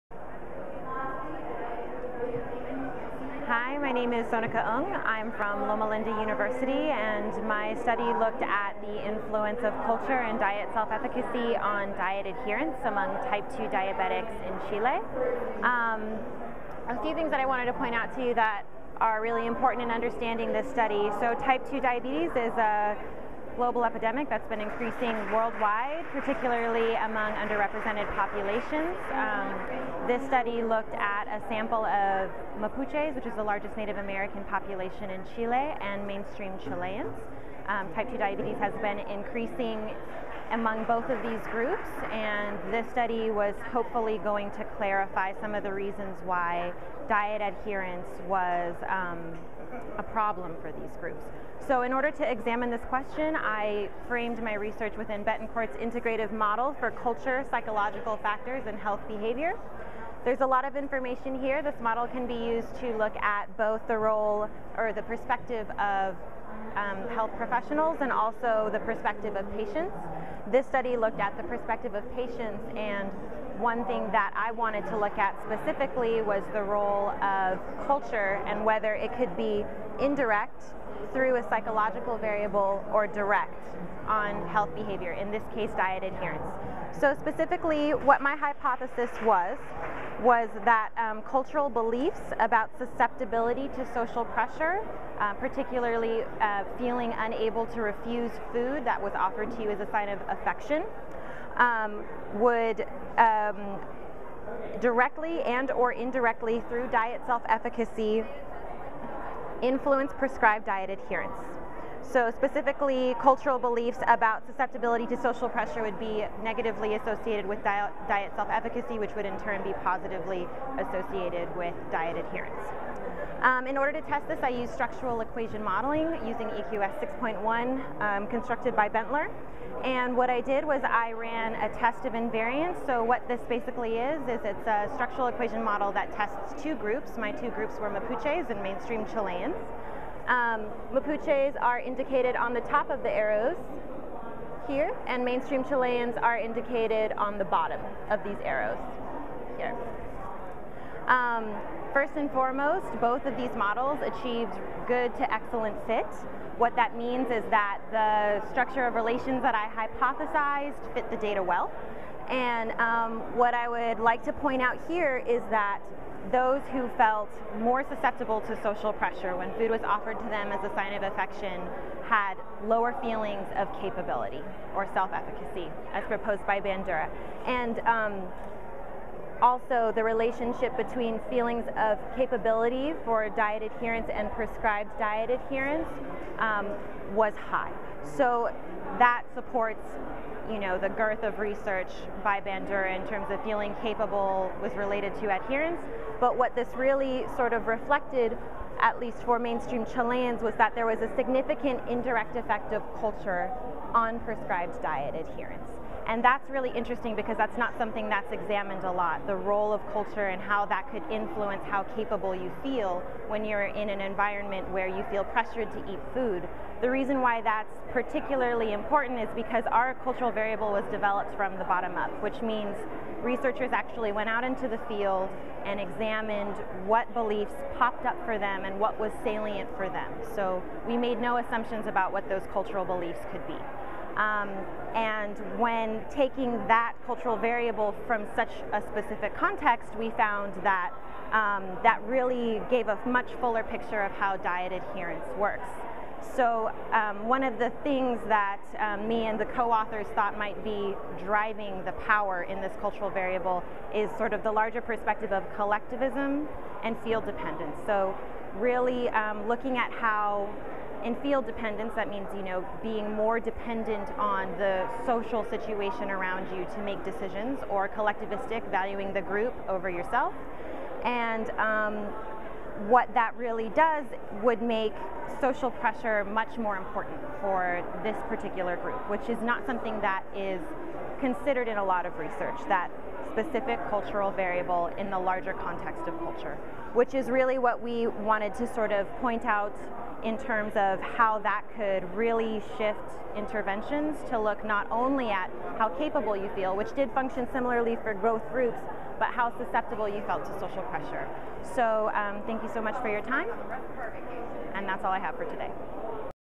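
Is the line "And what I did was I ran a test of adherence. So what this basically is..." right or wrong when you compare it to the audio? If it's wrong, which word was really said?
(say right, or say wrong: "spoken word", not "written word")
wrong: "invariance", not "adherence".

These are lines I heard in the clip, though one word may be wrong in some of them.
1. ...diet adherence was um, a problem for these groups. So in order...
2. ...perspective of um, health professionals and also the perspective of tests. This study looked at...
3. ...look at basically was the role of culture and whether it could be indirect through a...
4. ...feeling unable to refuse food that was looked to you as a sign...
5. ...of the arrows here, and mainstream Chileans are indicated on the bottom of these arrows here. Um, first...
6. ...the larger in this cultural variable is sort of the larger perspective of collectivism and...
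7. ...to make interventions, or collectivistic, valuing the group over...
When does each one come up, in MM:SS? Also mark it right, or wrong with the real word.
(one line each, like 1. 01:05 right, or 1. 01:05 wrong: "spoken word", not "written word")
1. 00:47 right
2. 01:05 wrong: "patients", not "tests"
3. 01:14 wrong: "specifically", not "basically"
4. 01:36 wrong: "offered", not "looked"
5. 02:22 right
6. 04:11 wrong: "power", not "larger"
7. 04:26 wrong: "decisions", not "interventions".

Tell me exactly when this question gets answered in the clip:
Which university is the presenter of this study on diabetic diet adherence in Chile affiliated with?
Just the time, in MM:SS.
00:05.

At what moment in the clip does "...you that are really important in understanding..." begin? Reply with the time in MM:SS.
00:18.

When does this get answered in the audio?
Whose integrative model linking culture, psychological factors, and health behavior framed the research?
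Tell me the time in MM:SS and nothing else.
00:55.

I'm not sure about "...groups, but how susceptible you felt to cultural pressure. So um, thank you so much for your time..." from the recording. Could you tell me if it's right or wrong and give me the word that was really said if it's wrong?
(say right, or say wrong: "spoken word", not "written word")
wrong: "social", not "cultural".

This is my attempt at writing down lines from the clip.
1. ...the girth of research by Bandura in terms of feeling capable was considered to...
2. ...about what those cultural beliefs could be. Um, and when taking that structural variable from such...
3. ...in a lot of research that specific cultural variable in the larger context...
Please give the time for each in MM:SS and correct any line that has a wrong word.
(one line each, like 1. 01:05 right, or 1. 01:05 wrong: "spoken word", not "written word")
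1. 03:10 wrong: "related", not "considered"
2. 03:51 wrong: "cultural", not "structural"
3. 04:41 right.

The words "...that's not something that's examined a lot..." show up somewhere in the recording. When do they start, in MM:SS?
03:27.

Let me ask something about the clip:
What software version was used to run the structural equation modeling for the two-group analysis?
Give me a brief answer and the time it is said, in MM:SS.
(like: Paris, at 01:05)
EQS 6.1, at 02:06.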